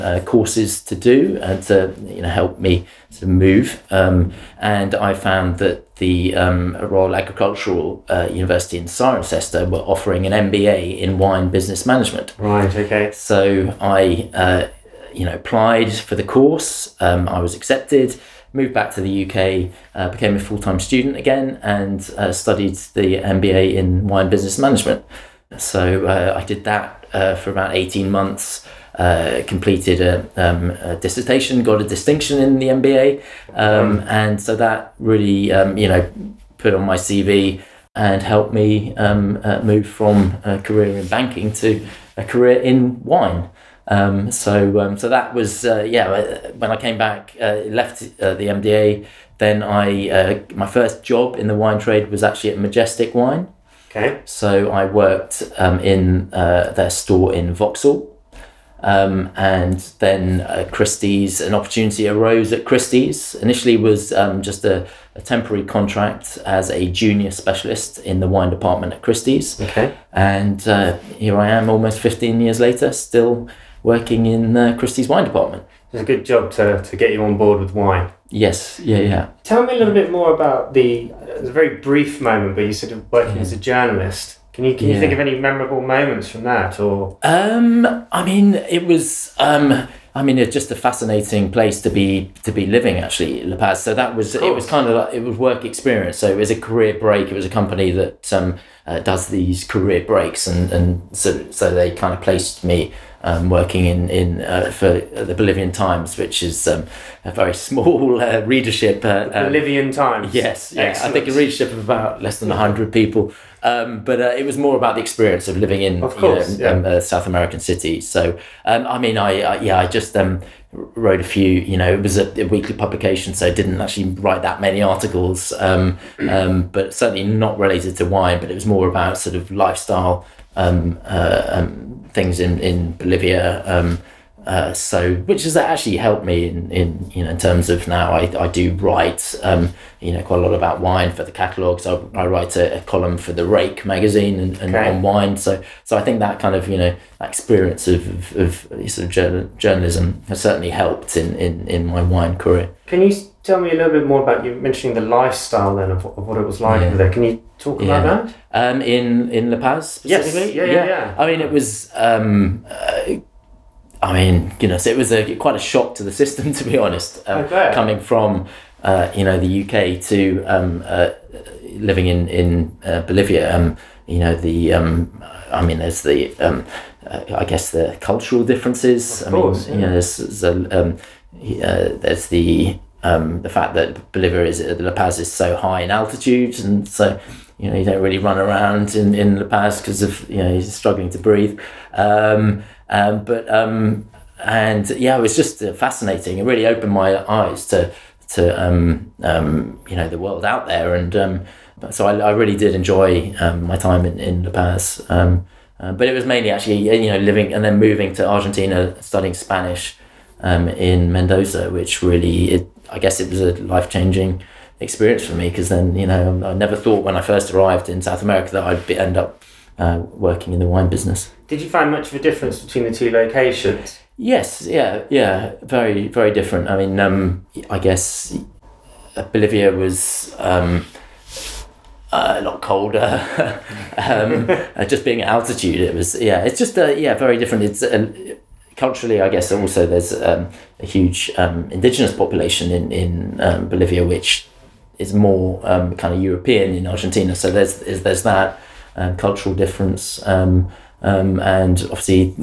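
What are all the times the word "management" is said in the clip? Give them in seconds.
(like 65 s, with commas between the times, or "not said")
11 s, 24 s.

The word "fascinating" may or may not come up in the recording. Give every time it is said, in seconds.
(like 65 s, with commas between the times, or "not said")
90 s, 195 s.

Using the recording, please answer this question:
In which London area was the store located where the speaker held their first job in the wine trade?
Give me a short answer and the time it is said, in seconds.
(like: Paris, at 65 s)
Vauxhall, at 57 s.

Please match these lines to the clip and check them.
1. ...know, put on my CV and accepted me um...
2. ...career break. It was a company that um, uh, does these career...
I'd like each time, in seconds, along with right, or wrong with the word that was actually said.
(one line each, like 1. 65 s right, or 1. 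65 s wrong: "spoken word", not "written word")
1. 35 s wrong: "helped", not "accepted"
2. 96 s right.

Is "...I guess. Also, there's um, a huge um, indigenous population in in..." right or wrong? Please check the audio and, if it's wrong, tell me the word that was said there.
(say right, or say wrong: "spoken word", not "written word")
right.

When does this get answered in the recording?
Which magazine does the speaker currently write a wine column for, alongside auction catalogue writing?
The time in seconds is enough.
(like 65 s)
143 s.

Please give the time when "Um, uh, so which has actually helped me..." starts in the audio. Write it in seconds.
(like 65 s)
133 s.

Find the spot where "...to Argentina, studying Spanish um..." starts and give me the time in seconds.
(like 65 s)
208 s.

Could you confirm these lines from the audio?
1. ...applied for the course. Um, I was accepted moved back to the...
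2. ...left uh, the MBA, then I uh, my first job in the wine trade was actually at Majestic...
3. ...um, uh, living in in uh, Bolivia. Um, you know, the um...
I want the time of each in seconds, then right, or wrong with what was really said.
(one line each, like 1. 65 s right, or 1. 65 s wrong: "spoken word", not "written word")
1. 15 s right
2. 47 s right
3. 170 s right.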